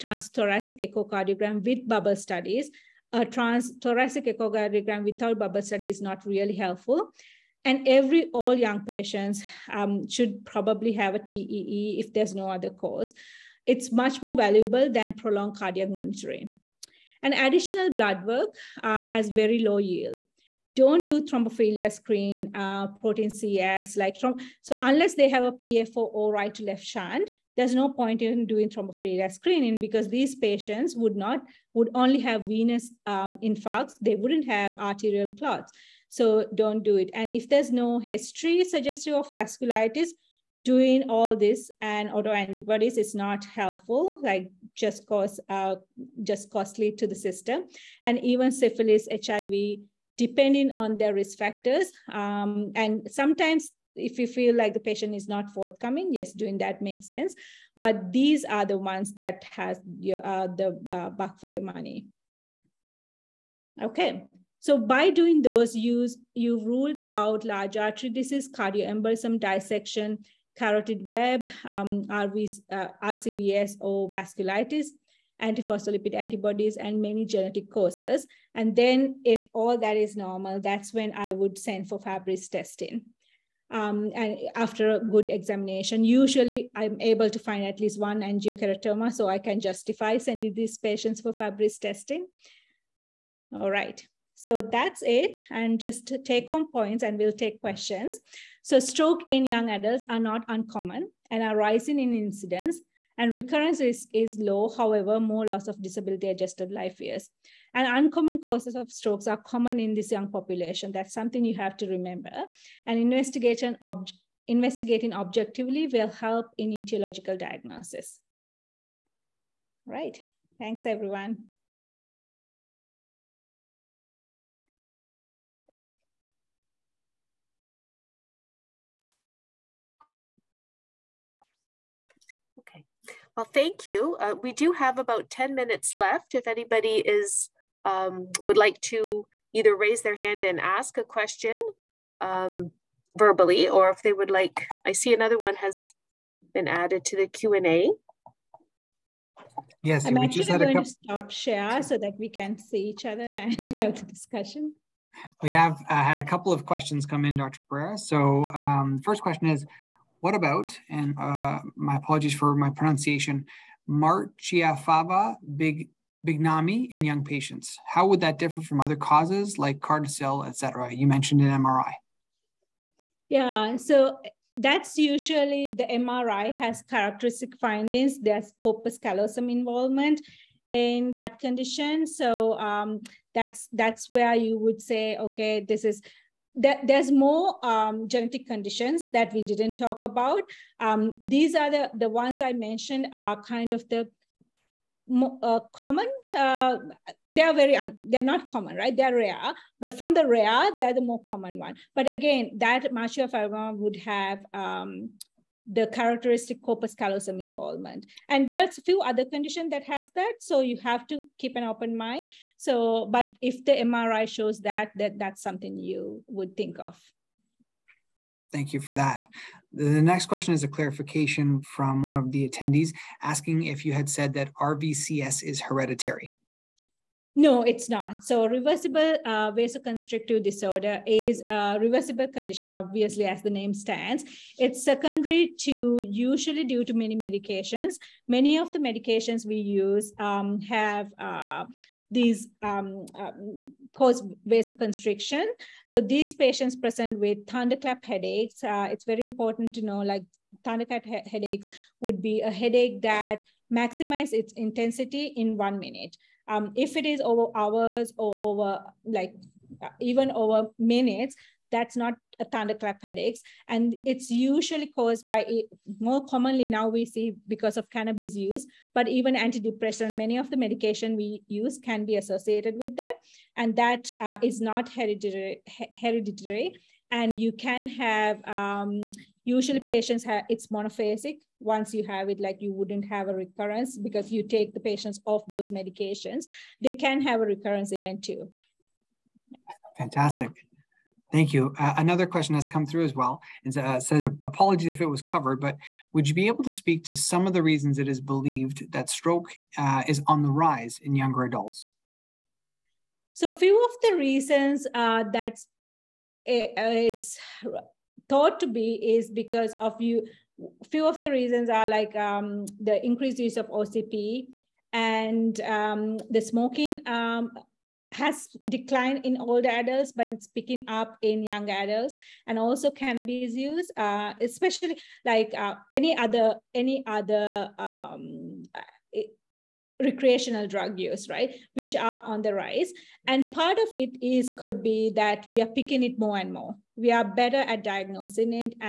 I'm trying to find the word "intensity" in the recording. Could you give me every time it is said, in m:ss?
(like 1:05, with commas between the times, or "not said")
4:14.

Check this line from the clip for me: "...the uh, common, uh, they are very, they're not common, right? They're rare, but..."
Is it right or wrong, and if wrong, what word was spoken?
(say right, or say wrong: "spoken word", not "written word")
right.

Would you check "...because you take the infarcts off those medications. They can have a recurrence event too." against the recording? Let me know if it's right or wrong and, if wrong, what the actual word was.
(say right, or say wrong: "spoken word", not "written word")
wrong: "patients", not "infarcts".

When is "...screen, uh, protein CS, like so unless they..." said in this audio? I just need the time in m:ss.
0:21.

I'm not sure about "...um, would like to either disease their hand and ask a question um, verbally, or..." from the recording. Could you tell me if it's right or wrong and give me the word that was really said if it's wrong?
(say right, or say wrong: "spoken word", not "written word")
wrong: "raise", not "disease".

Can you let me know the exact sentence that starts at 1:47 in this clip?
And uncommon causes of strokes are common in this young population.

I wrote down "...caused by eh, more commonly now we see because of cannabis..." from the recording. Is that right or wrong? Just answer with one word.
right.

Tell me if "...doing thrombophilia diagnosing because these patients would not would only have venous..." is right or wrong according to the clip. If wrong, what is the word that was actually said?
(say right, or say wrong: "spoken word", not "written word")
wrong: "screening", not "diagnosing".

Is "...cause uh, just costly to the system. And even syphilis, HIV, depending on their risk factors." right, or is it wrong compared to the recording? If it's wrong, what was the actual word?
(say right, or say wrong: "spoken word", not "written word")
right.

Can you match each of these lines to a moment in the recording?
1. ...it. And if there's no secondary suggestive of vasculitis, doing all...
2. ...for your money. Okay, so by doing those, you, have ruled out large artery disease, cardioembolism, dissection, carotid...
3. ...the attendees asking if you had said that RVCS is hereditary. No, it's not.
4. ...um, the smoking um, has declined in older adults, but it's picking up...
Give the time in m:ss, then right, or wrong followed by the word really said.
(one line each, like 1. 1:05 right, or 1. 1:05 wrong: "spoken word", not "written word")
1. 0:36 wrong: "history", not "secondary"
2. 1:01 right
3. 3:42 right
4. 5:15 right.